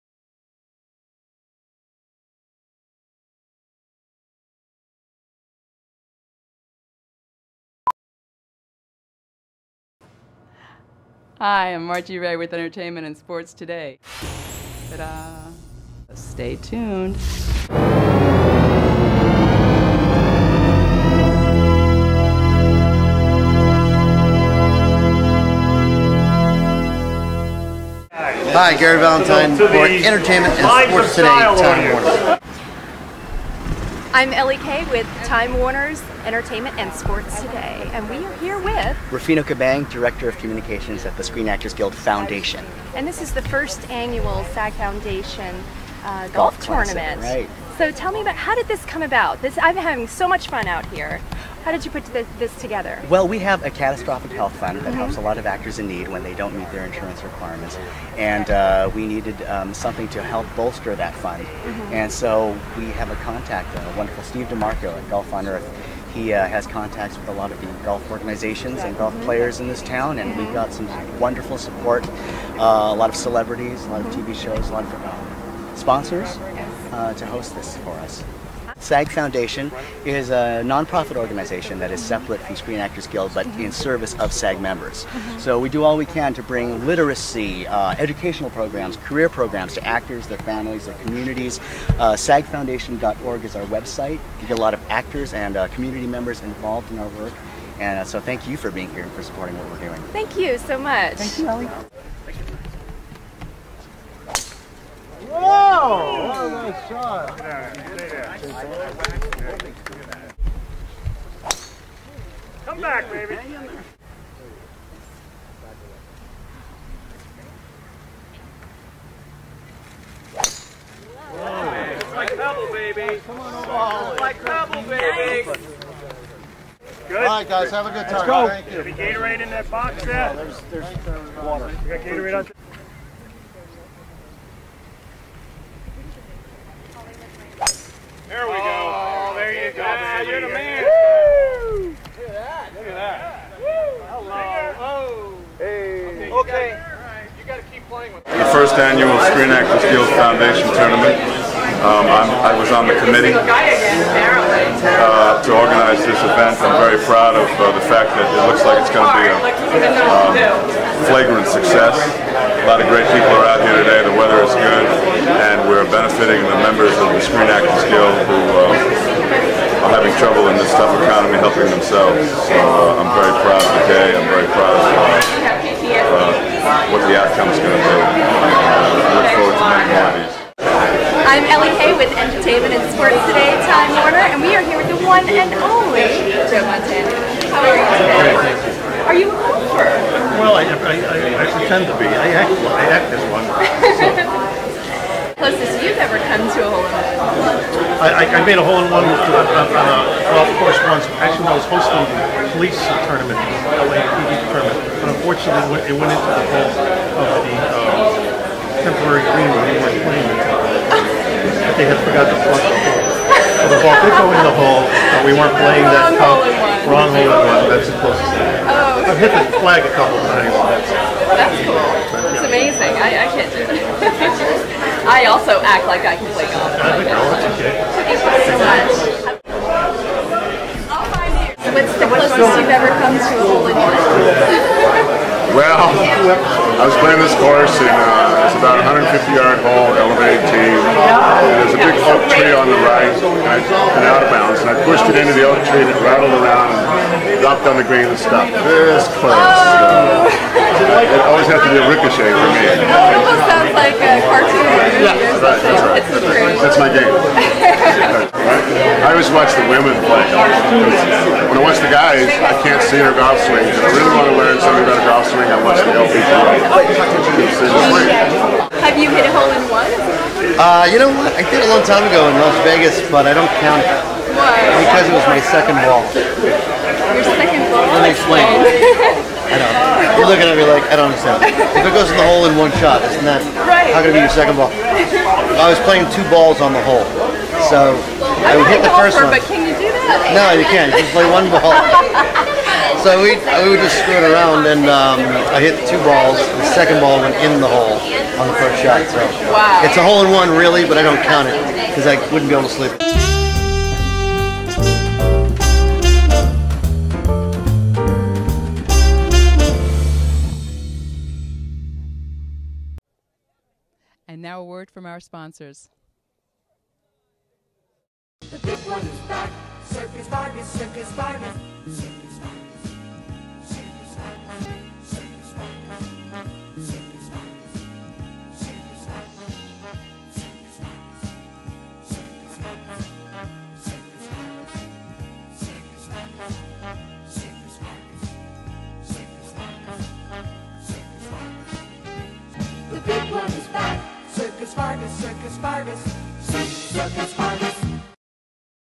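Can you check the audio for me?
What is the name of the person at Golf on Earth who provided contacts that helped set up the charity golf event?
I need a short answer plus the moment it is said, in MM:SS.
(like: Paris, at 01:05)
Steve DeMarco, at 01:04.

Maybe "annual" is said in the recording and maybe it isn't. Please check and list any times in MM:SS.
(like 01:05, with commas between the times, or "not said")
00:43, 02:28.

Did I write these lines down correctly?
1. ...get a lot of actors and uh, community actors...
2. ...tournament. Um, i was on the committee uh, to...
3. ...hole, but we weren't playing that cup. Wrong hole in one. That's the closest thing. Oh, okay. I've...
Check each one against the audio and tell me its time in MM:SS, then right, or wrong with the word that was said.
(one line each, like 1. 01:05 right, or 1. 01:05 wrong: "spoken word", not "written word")
1. 01:34 wrong: "members", not "actors"
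2. 02:30 right
3. 03:34 right.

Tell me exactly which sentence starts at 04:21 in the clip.
When I watch the guys, I can't see their golf swings.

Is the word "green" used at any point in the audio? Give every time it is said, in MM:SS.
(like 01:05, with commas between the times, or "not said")
03:29, 04:07.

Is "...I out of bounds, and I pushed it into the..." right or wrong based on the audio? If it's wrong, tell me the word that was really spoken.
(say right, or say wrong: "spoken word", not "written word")
right.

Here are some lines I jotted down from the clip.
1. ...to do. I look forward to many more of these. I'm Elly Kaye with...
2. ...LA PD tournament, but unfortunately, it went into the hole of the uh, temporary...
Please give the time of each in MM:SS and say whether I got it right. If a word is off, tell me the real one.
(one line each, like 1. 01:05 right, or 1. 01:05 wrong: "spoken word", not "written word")
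1. 02:57 right
2. 03:23 right.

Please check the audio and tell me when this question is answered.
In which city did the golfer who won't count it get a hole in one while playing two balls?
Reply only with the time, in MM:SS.
04:32.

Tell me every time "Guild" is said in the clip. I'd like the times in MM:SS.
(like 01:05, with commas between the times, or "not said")
00:41, 01:23, 02:29, 02:47.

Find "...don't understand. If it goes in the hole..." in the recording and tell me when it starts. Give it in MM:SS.
04:40.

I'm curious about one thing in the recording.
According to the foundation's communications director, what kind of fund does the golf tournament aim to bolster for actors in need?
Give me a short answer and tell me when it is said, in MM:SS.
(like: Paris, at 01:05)
catastrophic health fund, at 00:53.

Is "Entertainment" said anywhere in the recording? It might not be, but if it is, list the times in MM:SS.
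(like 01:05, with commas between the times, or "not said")
00:12, 00:29, 00:36, 03:02.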